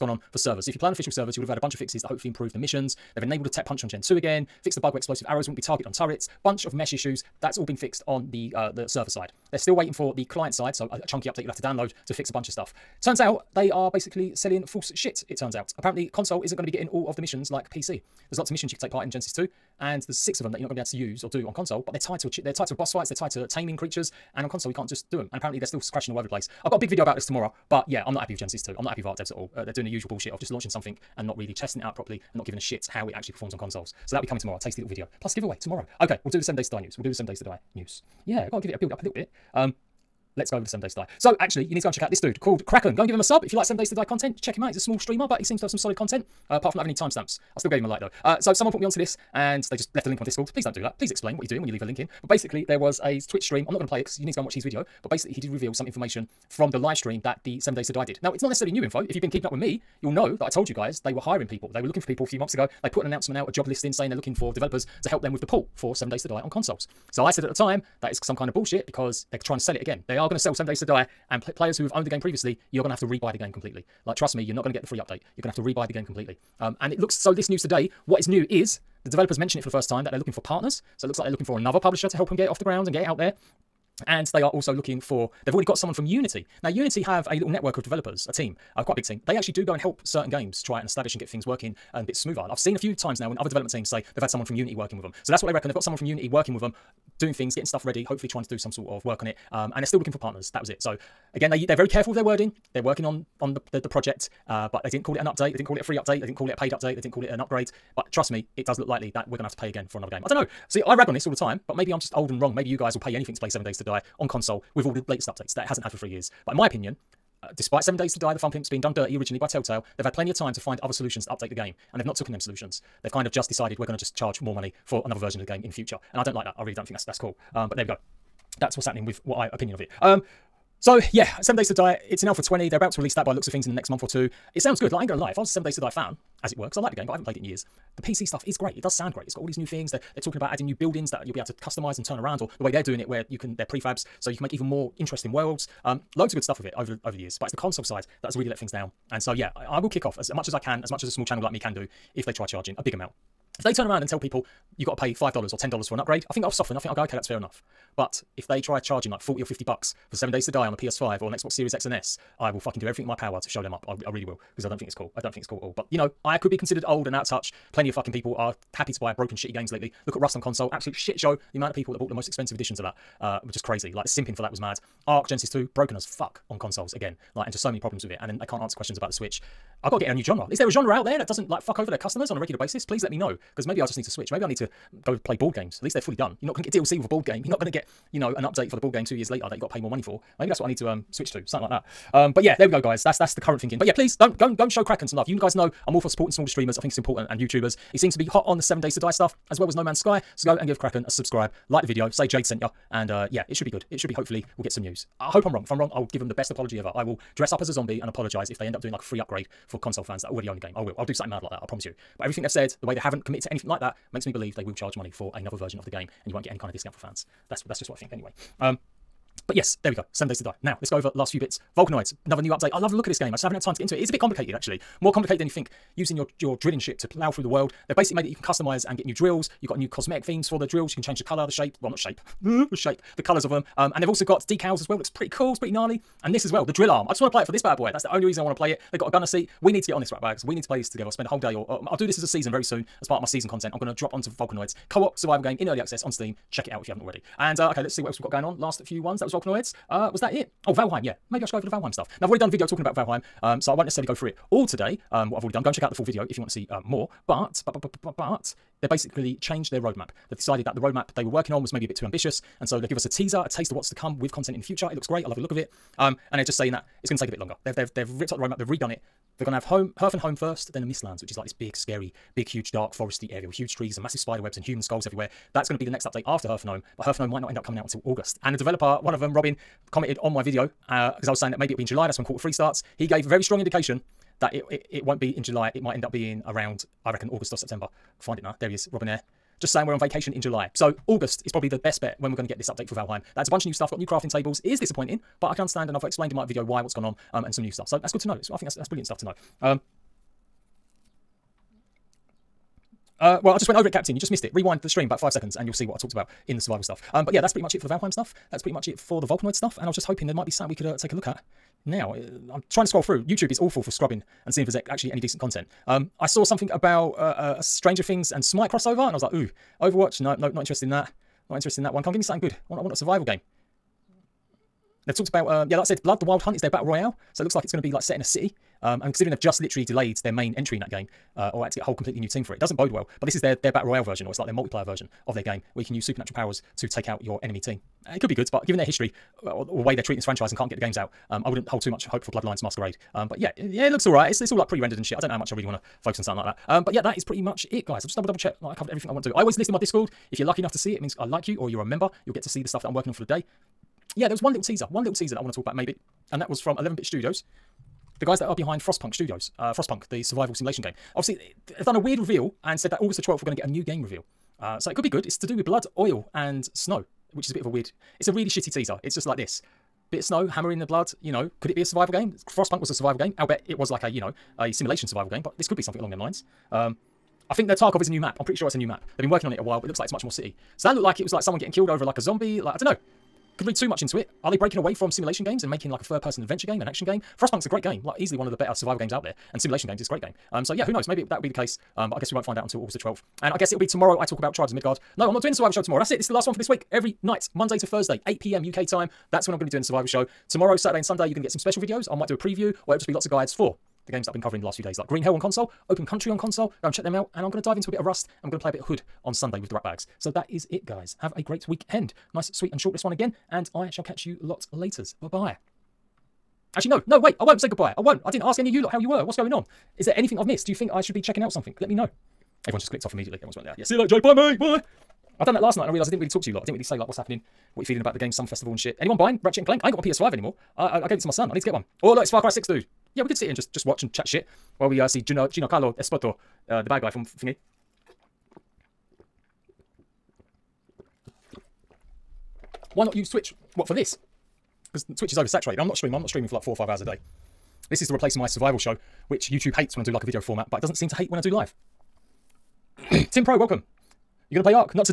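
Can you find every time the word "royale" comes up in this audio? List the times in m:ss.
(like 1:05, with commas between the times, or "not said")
5:26, 5:33.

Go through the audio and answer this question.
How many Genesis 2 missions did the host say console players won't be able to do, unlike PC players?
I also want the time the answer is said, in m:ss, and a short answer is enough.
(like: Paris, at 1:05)
6, at 0:20.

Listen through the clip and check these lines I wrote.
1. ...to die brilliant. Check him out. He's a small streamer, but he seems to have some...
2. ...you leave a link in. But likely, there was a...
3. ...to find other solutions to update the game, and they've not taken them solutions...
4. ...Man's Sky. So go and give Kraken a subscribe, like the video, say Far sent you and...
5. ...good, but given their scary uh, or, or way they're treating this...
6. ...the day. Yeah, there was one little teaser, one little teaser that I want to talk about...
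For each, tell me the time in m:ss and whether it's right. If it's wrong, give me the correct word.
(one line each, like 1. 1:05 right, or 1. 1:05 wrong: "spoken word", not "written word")
1. 0:43 wrong: "content", not "brilliant"
2. 0:51 wrong: "basically", not "likely"
3. 2:00 right
4. 3:19 wrong: "Jade", not "Far"
5. 5:38 wrong: "history", not "scary"
6. 5:53 right.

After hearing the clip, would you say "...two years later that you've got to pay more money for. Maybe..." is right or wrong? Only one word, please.
right.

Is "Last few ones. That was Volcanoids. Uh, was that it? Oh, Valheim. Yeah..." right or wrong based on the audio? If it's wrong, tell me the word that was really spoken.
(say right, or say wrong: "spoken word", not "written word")
right.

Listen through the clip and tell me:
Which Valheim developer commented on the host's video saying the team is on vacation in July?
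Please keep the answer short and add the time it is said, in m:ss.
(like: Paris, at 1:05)
Robin Eyre, at 4:48.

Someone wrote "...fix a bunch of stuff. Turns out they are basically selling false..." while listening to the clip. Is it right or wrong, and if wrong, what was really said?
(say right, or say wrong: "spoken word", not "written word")
right.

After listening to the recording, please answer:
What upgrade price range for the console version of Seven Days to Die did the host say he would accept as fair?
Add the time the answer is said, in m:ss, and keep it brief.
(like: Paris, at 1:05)
$5 or $10, at 2:35.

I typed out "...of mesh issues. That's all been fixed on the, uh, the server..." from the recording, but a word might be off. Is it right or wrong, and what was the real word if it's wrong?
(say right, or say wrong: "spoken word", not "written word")
right.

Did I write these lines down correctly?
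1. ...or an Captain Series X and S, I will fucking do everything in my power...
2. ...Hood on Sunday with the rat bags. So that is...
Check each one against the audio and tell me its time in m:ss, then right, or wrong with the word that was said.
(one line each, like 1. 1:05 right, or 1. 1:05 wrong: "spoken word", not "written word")
1. 2:41 wrong: "Xbox", not "Captain"
2. 6:48 right.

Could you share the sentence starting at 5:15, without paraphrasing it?
Um, I saw something about uh, uh, a Stranger Things and Smite crossover, and I was like, ooh, Overwatch?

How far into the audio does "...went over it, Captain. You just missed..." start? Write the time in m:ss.
5:03.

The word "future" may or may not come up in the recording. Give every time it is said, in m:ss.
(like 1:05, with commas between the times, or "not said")
2:05, 4:24.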